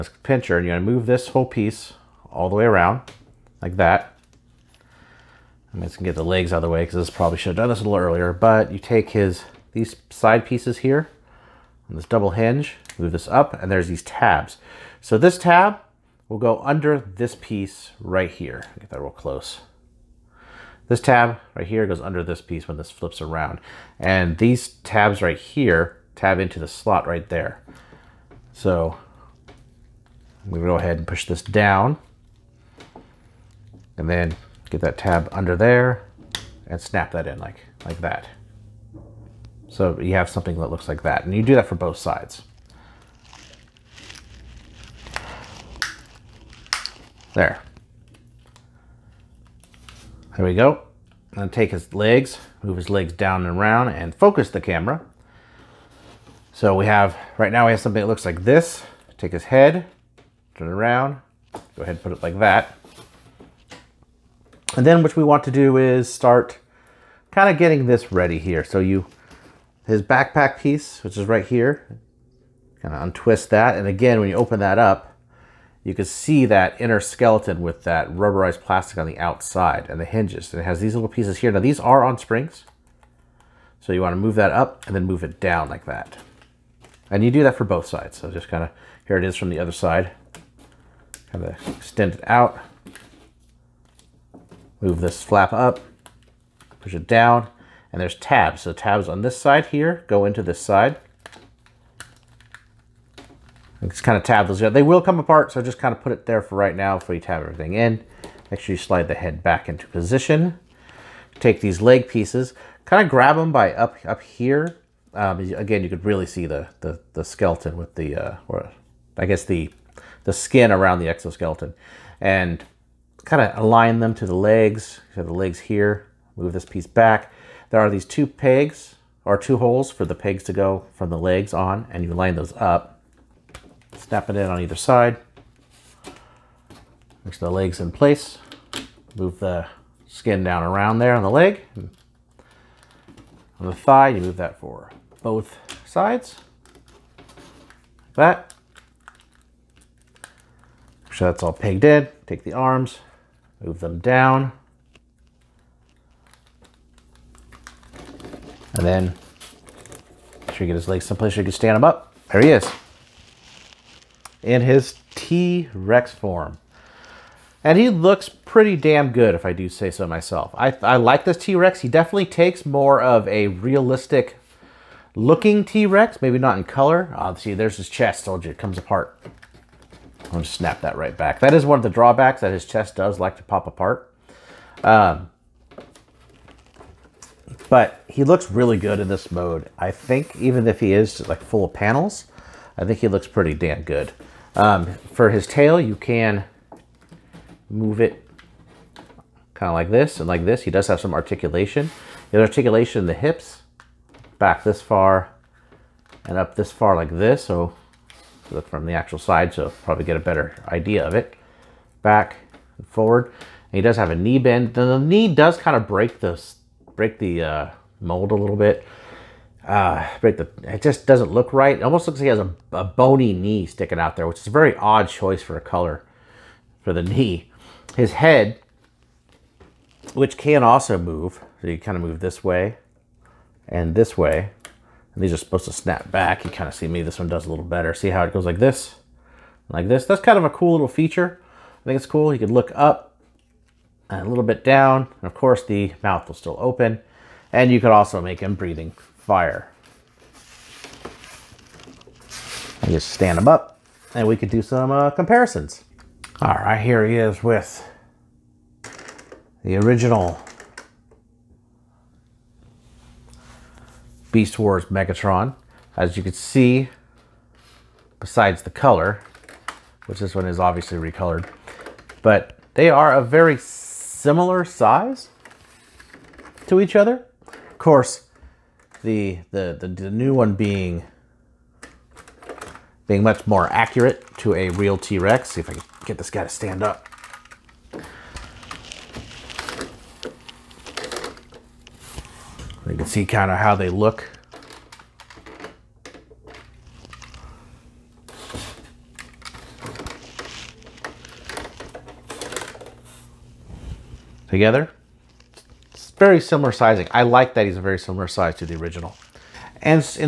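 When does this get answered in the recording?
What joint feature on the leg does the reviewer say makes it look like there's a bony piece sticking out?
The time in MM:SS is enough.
03:34.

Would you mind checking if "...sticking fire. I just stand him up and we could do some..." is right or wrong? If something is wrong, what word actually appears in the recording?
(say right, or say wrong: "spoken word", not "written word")
wrong: "breathing", not "sticking".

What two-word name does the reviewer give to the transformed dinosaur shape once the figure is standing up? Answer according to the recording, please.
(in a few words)
T-Rex form.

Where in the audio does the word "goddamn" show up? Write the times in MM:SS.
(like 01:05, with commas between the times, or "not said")
not said.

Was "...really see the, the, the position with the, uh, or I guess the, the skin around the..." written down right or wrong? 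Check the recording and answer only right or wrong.
wrong.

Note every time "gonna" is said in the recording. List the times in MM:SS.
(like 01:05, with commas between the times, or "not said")
00:00, 00:05, 03:00.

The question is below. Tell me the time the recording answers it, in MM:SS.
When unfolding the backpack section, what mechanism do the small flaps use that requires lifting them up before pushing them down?
01:22.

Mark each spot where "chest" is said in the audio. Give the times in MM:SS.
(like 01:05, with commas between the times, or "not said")
02:57, 03:02.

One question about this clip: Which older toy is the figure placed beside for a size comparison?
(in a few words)
original Beast Wars Megatron.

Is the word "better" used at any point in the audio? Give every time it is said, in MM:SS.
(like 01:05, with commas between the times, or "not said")
03:30, 03:57.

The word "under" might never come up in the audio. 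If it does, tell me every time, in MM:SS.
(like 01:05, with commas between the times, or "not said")
00:16, 00:22, 00:35.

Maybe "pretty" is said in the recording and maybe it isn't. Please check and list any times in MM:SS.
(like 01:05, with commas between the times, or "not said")
02:48, 03:13.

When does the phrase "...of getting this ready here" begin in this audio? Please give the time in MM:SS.
01:07.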